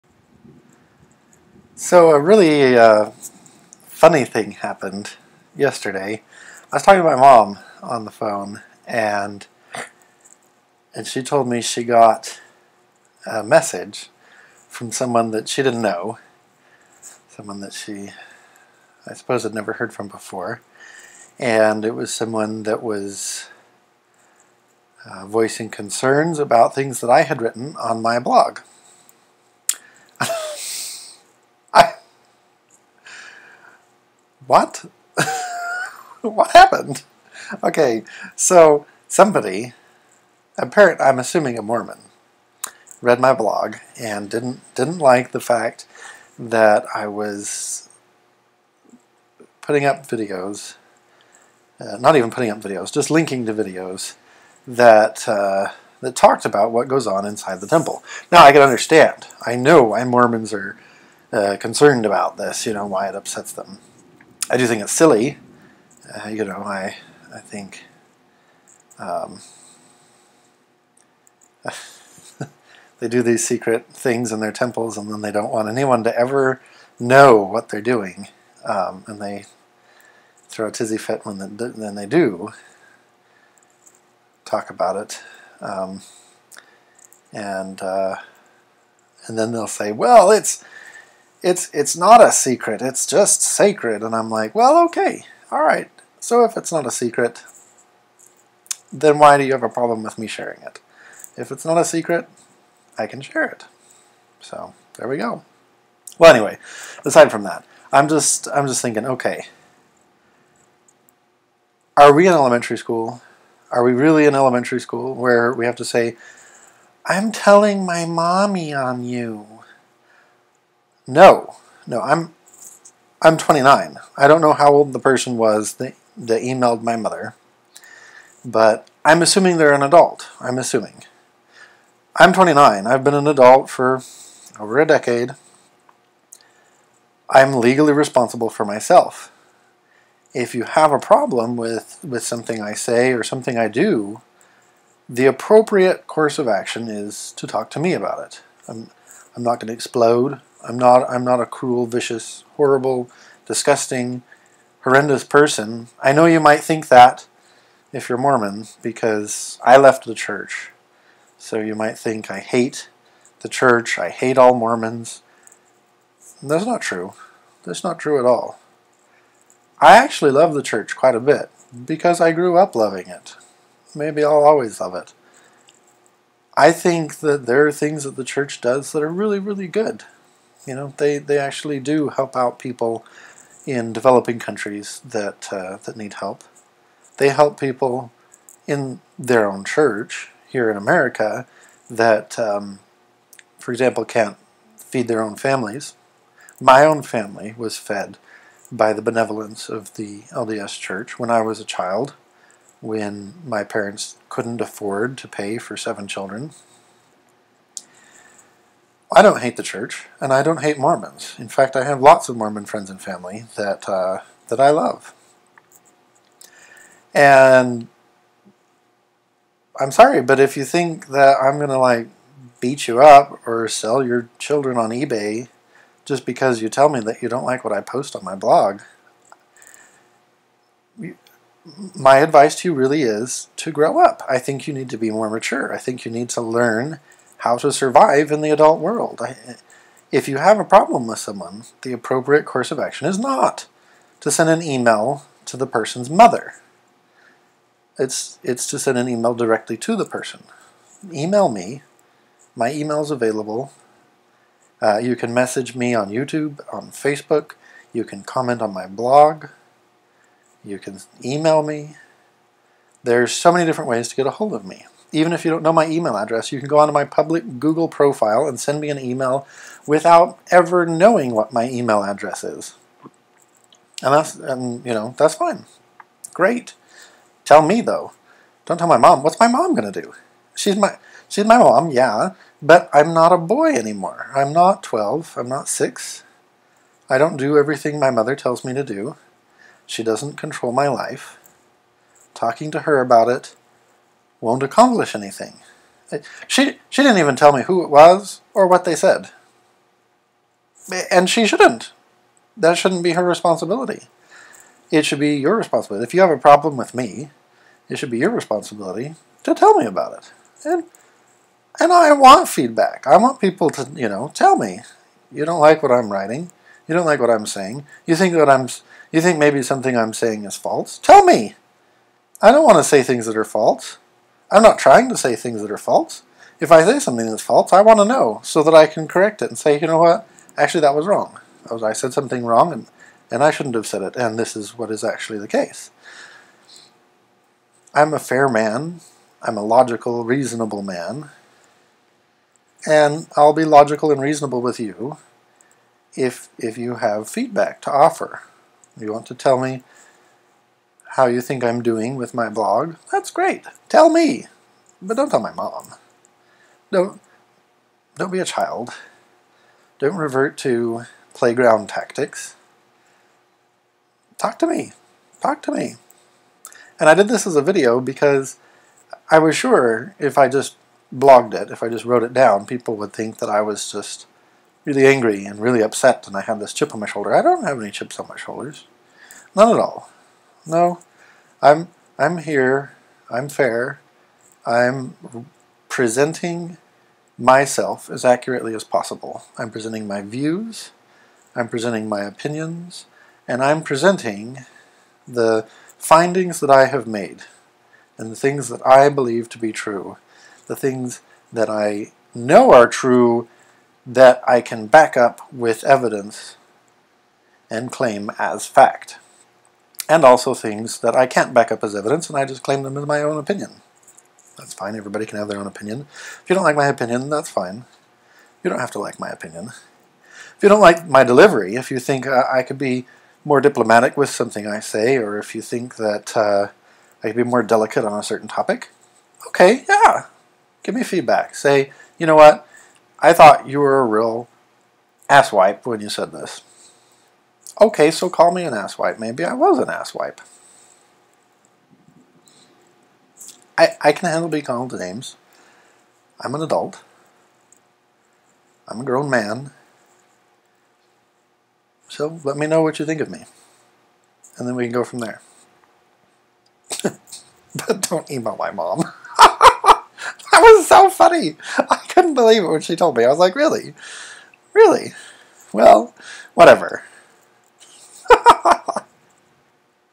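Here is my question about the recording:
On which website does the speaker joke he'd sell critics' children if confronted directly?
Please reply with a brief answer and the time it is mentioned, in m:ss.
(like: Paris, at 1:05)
eBay, at 3:44.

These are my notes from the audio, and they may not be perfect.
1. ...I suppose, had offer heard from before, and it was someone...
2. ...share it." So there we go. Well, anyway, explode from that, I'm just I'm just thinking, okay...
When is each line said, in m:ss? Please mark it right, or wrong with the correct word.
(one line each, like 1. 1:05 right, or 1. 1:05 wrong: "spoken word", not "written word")
1. 0:19 wrong: "never", not "offer"
2. 1:43 wrong: "aside", not "explode".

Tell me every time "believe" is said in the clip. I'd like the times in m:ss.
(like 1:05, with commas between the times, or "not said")
6:39, 7:42.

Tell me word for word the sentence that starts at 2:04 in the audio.
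I don't know how old the person was that, that emailed my mother, but I'm assuming they're an adult.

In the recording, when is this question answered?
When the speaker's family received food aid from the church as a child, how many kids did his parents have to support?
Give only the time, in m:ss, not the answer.
3:25.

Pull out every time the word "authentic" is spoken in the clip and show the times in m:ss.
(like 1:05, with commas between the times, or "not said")
not said.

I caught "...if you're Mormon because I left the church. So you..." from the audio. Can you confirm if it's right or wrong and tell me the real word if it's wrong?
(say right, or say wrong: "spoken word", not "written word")
right.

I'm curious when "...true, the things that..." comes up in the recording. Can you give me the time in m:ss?
6:39.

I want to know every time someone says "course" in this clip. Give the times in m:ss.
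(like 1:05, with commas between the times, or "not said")
2:26, 4:02.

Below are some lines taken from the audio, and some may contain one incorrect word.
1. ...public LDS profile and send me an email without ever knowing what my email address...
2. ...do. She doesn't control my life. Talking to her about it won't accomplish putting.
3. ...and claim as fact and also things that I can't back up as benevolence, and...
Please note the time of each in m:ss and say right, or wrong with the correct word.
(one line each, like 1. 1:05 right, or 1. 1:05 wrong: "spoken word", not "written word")
1. 4:27 wrong: "Google", not "LDS"
2. 4:48 wrong: "anything", not "putting"
3. 6:47 wrong: "evidence", not "benevolence".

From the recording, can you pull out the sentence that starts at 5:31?
was, I said something wrong and, and I shouldn't have said it, and this is what is actually the case.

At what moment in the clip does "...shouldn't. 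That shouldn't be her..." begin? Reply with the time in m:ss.
5:01.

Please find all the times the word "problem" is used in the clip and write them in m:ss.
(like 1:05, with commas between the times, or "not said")
1:39, 2:20, 4:00, 5:06.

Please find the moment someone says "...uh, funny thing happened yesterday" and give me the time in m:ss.
0:02.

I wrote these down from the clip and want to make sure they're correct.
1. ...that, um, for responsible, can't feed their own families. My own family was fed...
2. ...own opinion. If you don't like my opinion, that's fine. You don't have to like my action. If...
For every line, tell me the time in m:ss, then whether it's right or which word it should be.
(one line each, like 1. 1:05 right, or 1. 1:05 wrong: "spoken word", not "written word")
1. 3:11 wrong: "example", not "responsible"
2. 6:55 wrong: "opinion", not "action".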